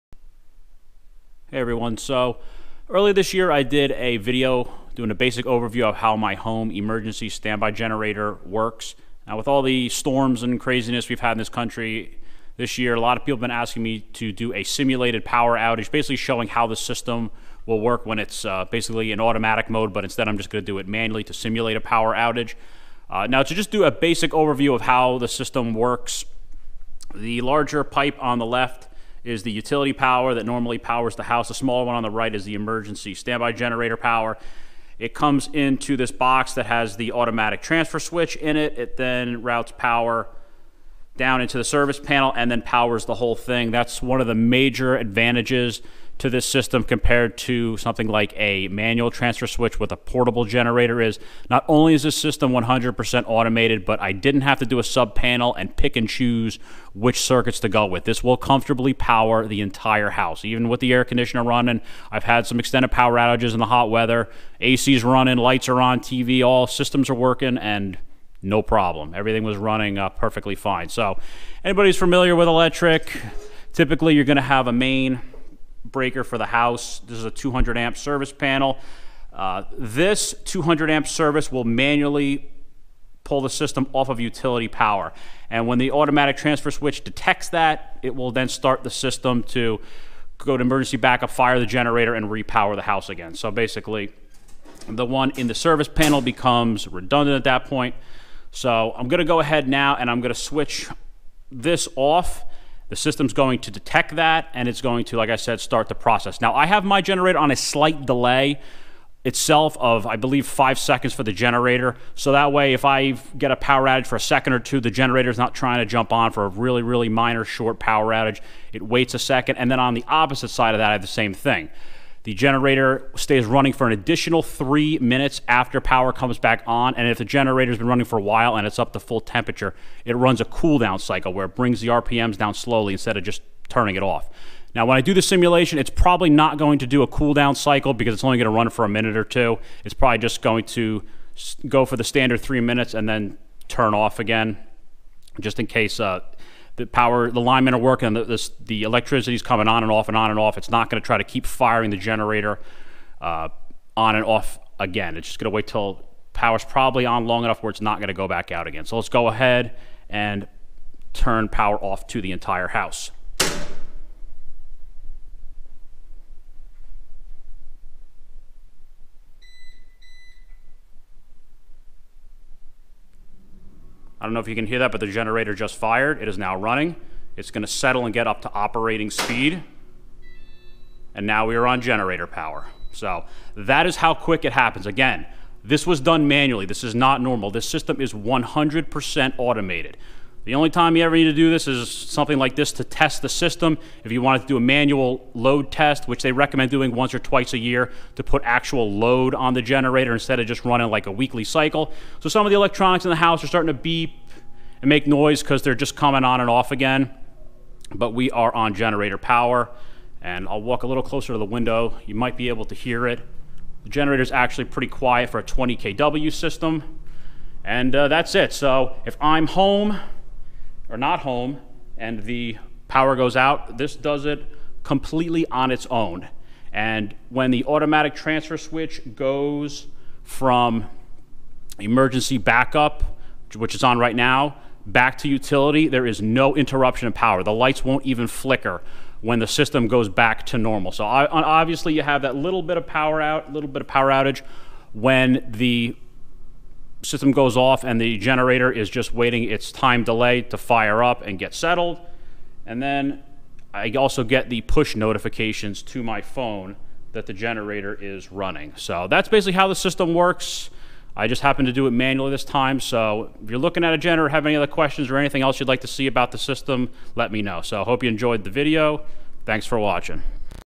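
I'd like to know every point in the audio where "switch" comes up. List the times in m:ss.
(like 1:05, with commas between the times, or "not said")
0:37, 0:49, 1:26, 1:40, 3:48.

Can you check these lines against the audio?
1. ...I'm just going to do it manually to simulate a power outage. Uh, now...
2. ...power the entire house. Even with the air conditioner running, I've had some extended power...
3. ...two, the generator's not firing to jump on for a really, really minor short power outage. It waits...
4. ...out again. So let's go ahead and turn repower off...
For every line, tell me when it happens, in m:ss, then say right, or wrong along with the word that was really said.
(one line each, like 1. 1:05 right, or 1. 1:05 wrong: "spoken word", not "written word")
1. 0:20 right
2. 0:58 right
3. 1:54 wrong: "trying", not "firing"
4. 2:38 wrong: "power", not "repower".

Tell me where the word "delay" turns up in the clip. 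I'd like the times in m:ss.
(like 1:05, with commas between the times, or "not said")
1:48, 4:10.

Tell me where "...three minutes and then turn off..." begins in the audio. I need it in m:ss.
2:22.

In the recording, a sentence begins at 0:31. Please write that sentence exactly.
The smaller one on the right is the emergency standby generator power.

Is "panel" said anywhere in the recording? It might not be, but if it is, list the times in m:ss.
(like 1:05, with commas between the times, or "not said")
0:41, 0:55, 1:18, 1:35.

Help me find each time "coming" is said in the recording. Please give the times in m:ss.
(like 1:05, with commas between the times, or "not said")
2:29, 3:25.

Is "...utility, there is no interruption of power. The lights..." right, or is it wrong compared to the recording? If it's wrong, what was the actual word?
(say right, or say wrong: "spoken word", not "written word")
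right.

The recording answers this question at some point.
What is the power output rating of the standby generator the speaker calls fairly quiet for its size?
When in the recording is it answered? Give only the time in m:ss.
3:35.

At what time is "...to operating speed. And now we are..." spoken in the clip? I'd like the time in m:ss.
2:58.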